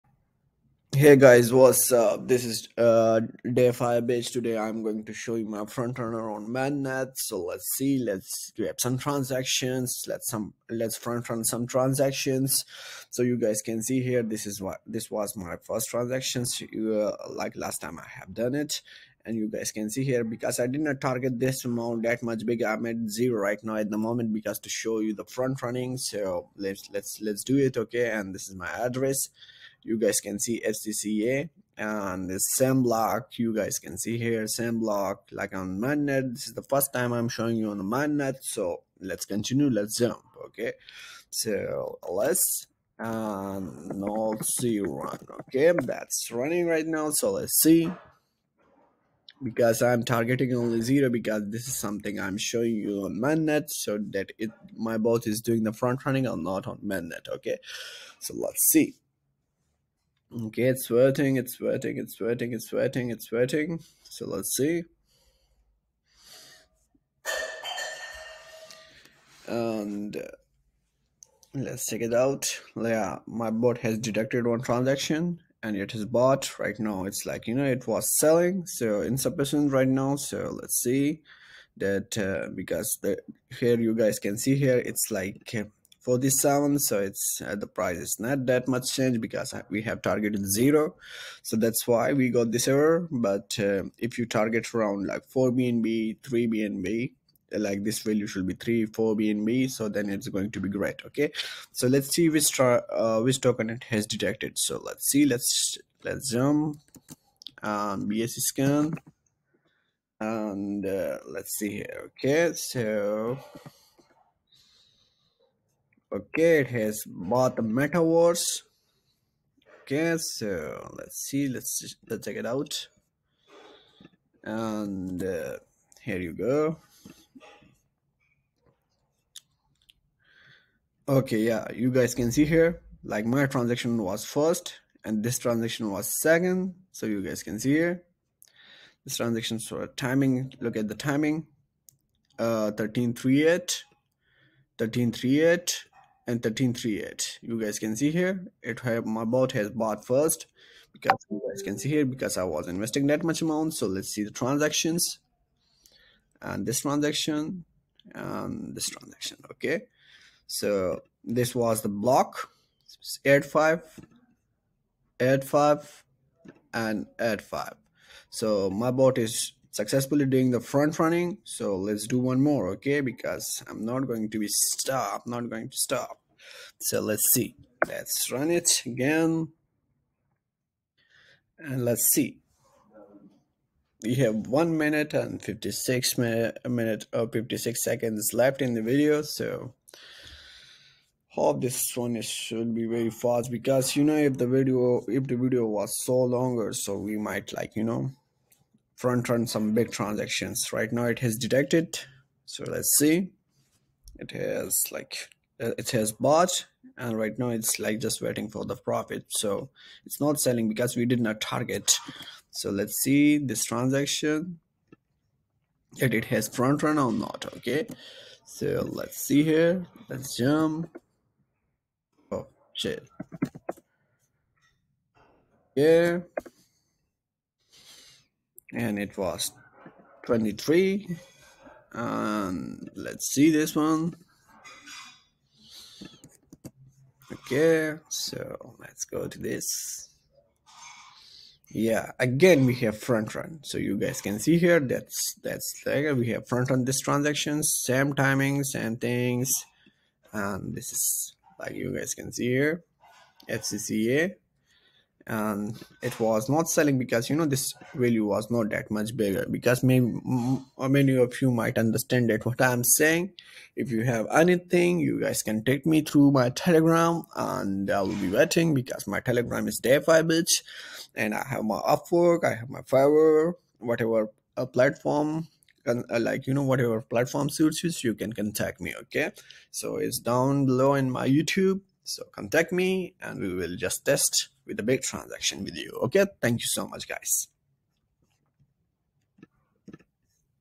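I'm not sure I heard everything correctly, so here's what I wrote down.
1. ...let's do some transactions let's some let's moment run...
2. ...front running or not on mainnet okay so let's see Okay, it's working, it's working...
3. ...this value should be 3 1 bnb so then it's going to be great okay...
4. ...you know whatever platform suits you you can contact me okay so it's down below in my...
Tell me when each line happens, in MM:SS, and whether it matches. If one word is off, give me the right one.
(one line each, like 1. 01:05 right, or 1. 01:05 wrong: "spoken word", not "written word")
1. 00:07 wrong: "front", not "moment"
2. 00:55 right
3. 01:37 wrong: "4", not "1"
4. 04:36 right.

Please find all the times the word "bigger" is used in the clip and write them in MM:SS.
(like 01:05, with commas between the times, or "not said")
00:22, 04:19.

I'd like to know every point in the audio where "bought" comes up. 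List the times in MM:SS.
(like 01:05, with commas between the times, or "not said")
01:16, 01:57, 02:29, 03:26.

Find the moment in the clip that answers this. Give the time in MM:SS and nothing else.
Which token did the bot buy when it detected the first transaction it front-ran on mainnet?
01:57.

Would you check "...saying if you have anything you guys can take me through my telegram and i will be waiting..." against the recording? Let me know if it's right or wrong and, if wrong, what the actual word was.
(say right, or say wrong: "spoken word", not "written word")
right.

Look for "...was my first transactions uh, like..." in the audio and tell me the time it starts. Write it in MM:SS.
00:15.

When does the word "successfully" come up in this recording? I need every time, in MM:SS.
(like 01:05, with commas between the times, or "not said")
02:49.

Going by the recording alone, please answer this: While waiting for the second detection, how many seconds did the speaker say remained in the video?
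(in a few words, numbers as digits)
56.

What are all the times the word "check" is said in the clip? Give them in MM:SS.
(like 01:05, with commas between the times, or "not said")
01:11, 02:02.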